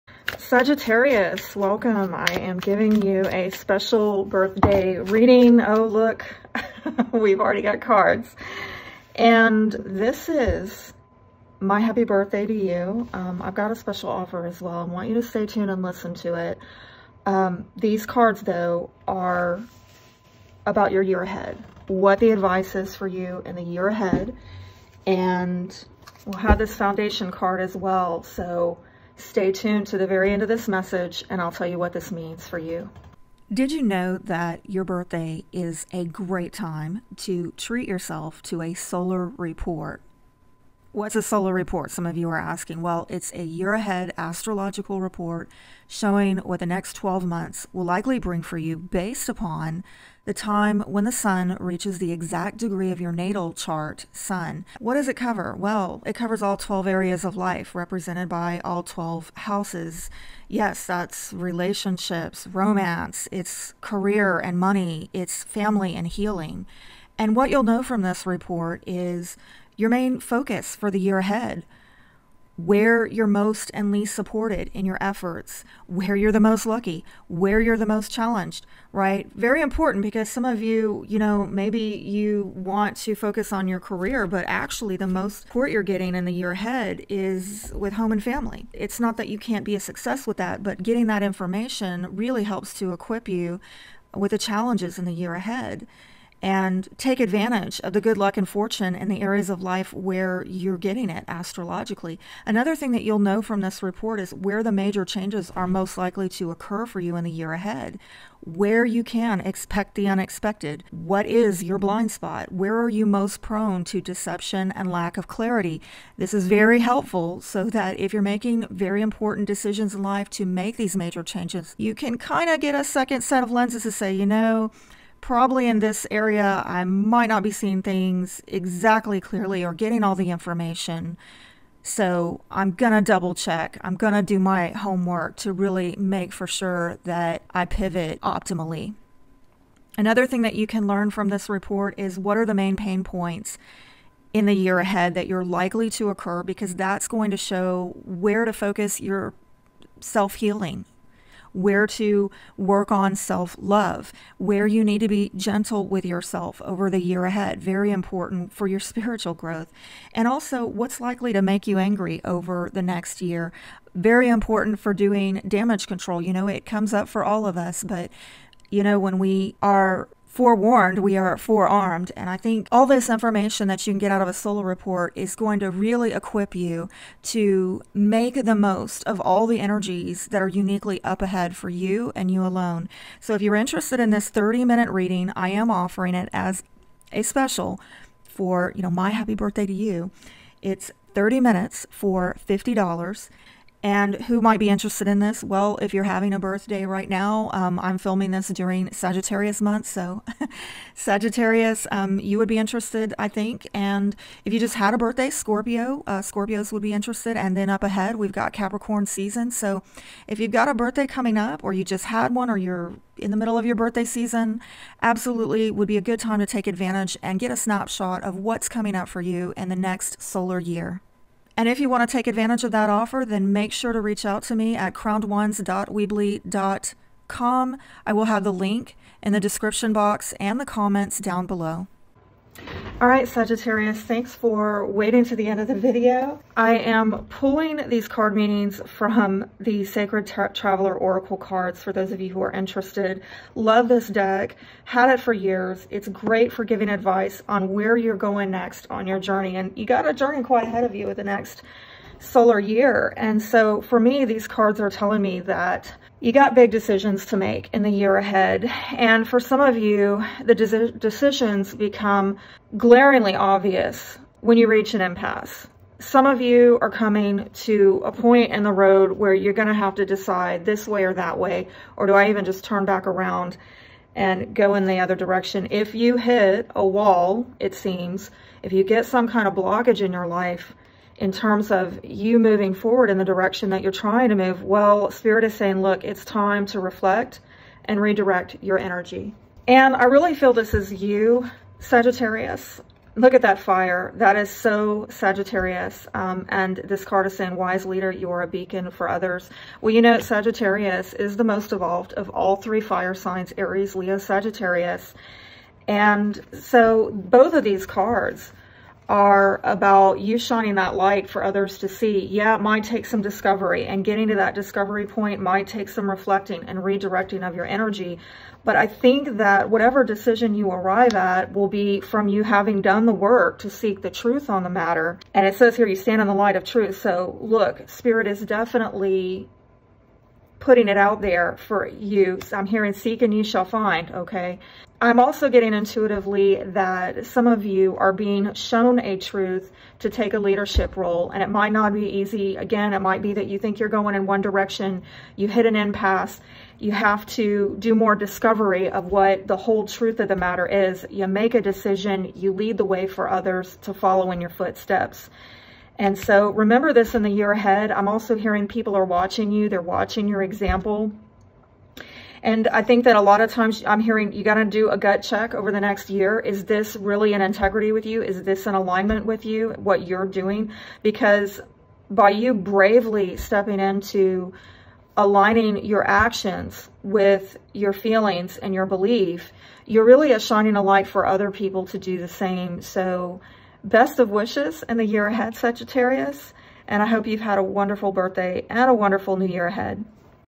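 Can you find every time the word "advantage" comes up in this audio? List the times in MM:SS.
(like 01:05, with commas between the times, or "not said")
01:37, 03:36, 03:42.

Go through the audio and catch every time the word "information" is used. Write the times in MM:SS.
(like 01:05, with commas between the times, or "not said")
01:31, 02:10, 02:53.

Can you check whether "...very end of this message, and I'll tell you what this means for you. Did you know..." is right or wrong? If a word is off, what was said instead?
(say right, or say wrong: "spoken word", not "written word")
right.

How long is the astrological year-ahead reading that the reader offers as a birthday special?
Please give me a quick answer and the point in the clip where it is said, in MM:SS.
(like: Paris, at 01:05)
30 minutes, at 03:04.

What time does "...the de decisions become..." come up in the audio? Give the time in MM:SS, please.
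04:20.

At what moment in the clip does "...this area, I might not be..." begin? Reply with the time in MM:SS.
02:05.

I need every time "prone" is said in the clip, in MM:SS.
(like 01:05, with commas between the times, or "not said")
01:53.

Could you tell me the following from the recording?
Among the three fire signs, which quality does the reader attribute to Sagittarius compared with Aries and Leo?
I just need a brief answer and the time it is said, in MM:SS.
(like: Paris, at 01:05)
most evolved, at 05:01.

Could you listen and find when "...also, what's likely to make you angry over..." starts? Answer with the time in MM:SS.
02:40.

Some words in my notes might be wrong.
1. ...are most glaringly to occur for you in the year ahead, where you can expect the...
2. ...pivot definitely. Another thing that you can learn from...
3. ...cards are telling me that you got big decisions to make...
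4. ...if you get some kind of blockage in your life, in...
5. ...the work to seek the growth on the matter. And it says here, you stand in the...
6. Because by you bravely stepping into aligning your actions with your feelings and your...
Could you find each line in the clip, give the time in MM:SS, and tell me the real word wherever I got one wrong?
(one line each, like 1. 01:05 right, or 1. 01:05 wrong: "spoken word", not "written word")
1. 01:45 wrong: "likely", not "glaringly"
2. 02:17 wrong: "optimally", not "definitely"
3. 04:14 right
4. 04:38 right
5. 05:23 wrong: "truth", not "growth"
6. 06:11 right.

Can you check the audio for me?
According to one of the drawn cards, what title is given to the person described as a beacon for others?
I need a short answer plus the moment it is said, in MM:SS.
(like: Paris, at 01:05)
wise leader, at 04:57.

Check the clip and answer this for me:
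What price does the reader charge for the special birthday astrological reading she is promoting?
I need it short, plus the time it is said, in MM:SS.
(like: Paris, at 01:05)
$50, at 03:12.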